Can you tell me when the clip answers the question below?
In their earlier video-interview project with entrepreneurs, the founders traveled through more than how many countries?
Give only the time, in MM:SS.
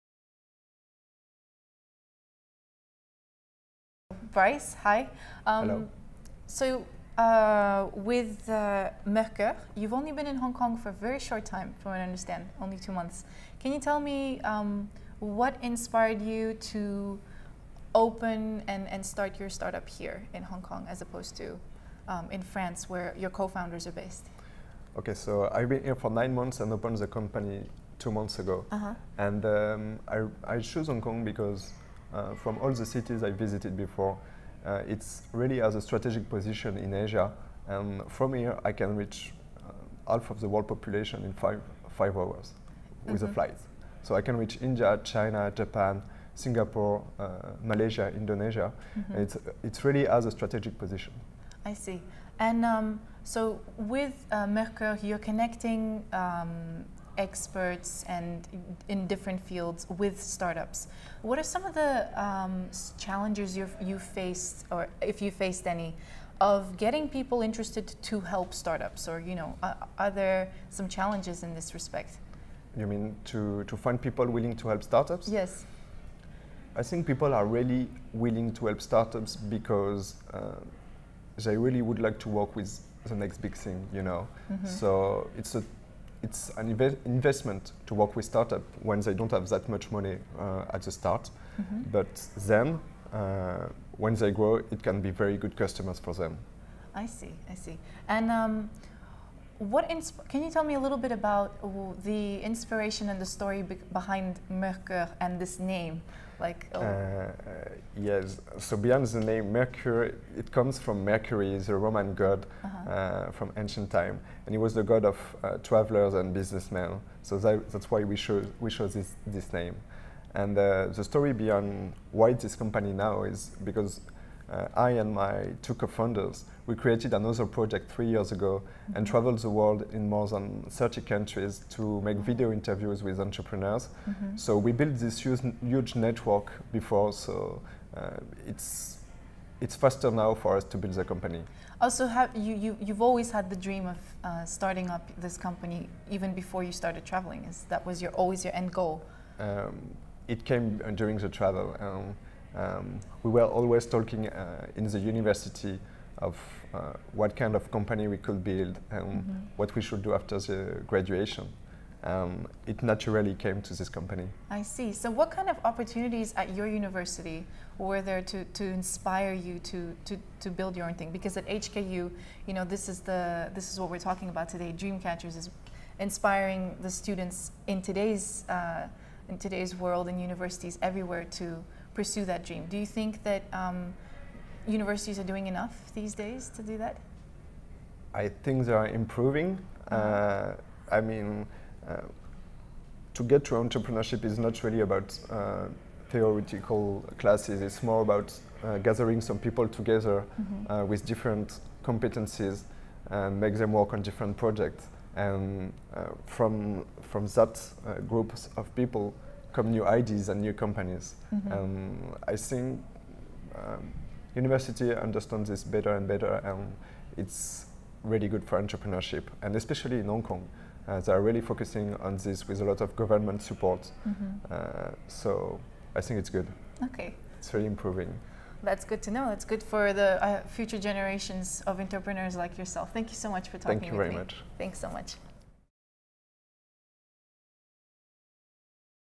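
02:10.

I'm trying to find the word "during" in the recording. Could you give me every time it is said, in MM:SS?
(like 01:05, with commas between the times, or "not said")
02:30.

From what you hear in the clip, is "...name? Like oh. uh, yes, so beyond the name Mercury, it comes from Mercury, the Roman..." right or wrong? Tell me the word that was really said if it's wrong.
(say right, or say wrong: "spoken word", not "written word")
right.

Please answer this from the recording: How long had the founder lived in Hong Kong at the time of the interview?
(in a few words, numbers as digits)
9 months.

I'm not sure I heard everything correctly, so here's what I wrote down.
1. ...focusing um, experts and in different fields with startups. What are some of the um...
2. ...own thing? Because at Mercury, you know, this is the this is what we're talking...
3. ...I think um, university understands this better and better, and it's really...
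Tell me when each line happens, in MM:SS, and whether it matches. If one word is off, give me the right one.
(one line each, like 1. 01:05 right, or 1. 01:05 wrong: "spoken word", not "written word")
1. 00:55 wrong: "connecting", not "focusing"
2. 02:50 wrong: "HKU", not "Mercury"
3. 03:32 right.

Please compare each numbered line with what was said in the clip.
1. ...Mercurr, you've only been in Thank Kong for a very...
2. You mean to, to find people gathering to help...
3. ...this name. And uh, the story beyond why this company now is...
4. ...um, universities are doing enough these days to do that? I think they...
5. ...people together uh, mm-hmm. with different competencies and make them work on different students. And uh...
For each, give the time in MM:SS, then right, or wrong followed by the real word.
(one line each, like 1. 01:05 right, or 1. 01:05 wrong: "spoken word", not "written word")
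1. 00:09 wrong: "Hong", not "Thank"
2. 01:12 wrong: "willing", not "gathering"
3. 01:59 right
4. 03:03 right
5. 03:19 wrong: "projects", not "students".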